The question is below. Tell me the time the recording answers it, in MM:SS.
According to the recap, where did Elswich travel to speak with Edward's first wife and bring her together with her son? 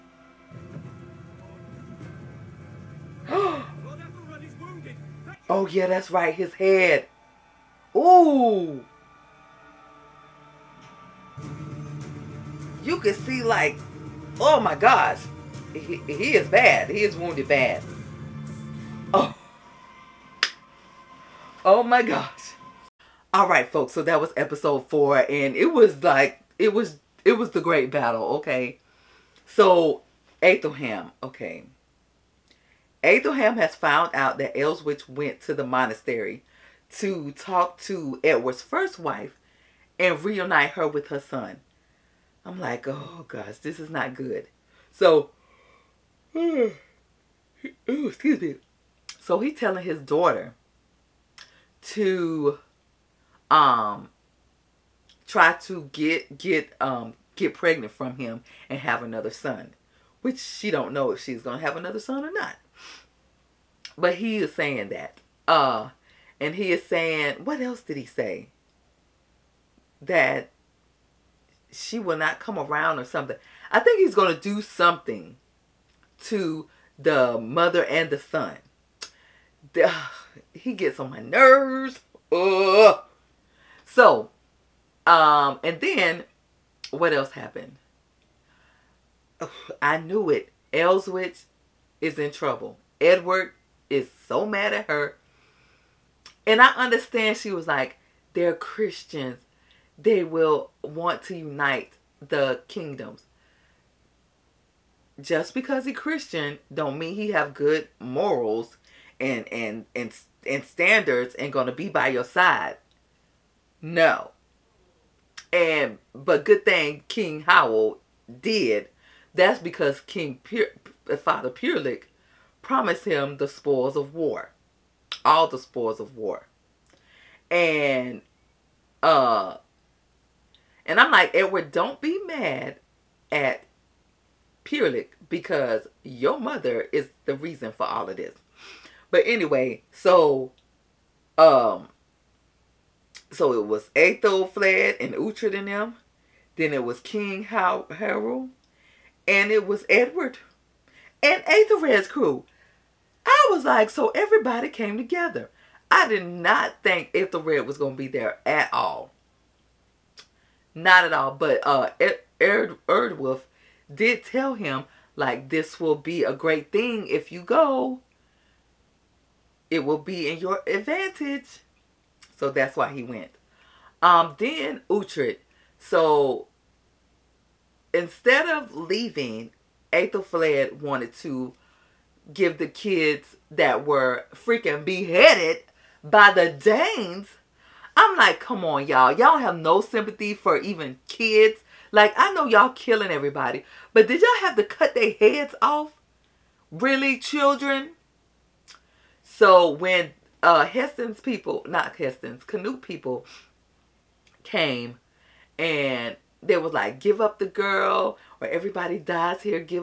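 00:35.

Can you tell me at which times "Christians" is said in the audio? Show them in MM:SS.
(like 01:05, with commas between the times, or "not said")
01:38, 01:45.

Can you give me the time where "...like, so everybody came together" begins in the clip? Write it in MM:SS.
02:33.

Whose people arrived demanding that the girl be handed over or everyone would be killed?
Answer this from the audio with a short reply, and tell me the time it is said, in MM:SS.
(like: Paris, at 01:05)
Canute, at 03:22.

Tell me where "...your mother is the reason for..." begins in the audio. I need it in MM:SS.
02:16.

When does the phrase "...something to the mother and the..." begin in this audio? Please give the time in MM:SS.
01:14.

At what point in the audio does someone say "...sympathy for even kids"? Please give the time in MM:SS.
03:09.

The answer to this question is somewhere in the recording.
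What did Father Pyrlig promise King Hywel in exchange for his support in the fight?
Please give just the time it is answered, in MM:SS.
02:05.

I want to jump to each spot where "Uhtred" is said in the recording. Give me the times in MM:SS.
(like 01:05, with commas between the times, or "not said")
02:25, 02:54.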